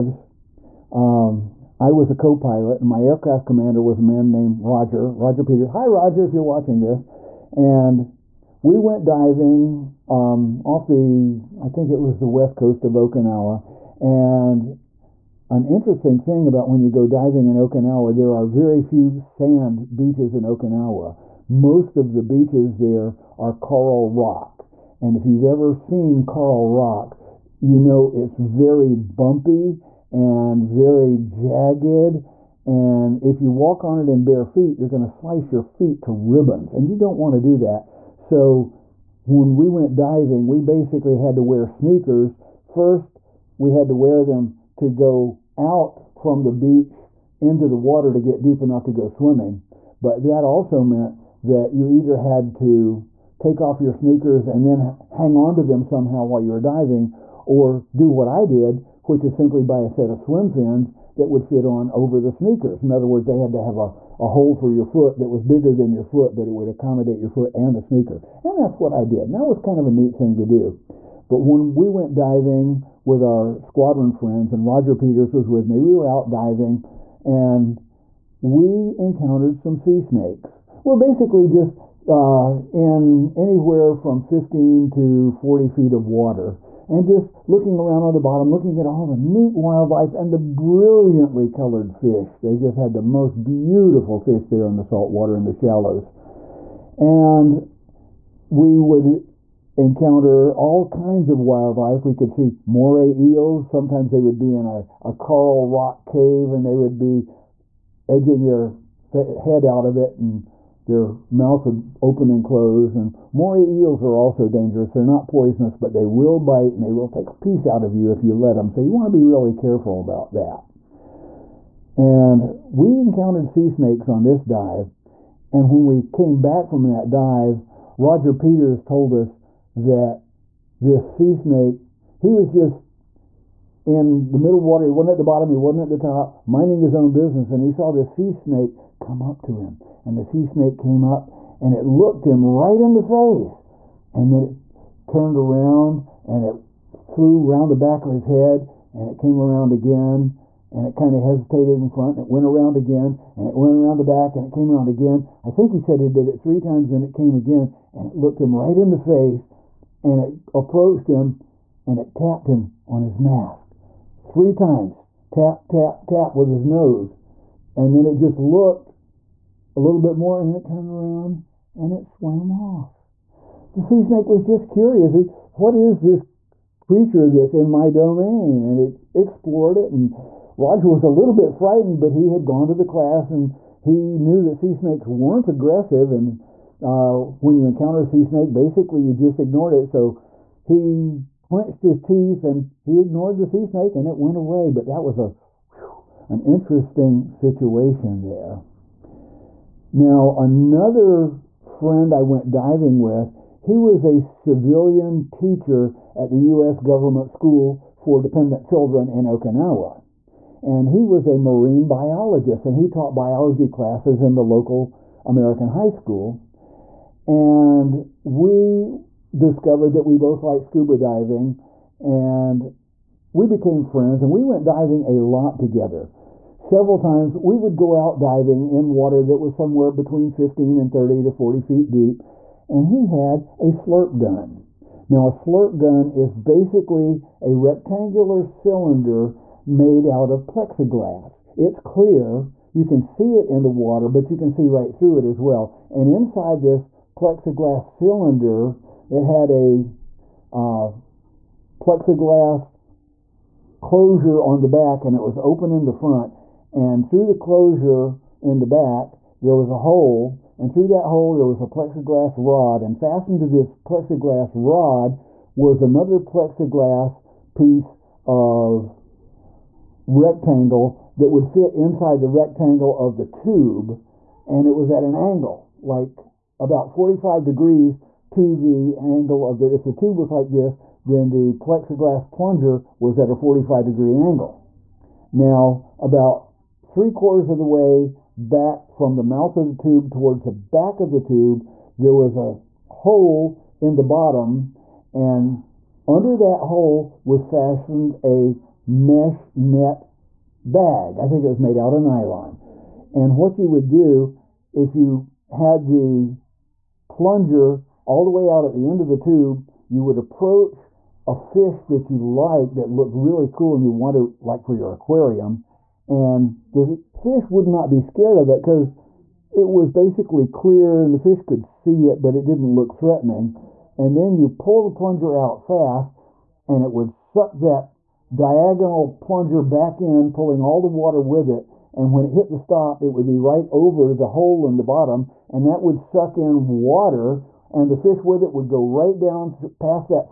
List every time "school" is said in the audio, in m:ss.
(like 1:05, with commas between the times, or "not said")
3:27, 3:35.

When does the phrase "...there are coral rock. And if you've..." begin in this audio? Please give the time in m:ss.
0:22.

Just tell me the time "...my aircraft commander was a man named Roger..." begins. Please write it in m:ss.
0:02.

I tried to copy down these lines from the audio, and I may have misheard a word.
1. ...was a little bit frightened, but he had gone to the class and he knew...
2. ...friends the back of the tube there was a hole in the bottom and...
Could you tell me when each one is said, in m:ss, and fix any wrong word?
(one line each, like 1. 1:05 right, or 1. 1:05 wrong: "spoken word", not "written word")
1. 3:00 right
2. 4:50 wrong: "towards", not "friends".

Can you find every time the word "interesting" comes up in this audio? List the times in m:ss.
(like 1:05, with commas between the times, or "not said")
0:15, 3:16.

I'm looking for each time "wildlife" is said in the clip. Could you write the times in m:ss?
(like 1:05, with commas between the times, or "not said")
1:29, 1:41.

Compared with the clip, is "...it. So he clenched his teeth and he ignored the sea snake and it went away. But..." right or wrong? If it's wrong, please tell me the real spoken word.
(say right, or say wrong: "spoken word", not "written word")
right.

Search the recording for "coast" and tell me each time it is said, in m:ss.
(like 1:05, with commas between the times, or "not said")
0:12.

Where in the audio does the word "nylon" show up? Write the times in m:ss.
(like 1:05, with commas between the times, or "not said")
5:02.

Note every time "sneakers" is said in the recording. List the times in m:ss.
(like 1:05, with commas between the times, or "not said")
0:41, 0:53, 1:02, 1:07.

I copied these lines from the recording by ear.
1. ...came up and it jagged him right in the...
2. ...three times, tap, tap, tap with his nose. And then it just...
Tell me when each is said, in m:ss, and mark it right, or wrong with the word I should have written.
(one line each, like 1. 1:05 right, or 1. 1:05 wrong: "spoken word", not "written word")
1. 2:20 wrong: "looked", not "jagged"
2. 2:44 right.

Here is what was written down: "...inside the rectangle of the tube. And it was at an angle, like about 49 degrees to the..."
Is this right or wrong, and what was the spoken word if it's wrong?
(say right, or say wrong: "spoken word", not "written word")
wrong: "45", not "49".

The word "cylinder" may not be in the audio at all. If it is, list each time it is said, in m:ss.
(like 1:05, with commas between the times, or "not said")
3:58, 4:07.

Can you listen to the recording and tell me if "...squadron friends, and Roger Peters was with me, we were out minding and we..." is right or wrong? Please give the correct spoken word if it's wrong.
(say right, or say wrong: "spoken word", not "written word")
wrong: "diving", not "minding".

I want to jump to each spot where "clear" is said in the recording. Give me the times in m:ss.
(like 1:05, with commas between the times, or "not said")
4:01, 5:20.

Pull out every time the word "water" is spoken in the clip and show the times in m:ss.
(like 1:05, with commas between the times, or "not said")
0:47, 1:26, 1:35, 2:14, 3:48, 4:03, 5:30, 5:36.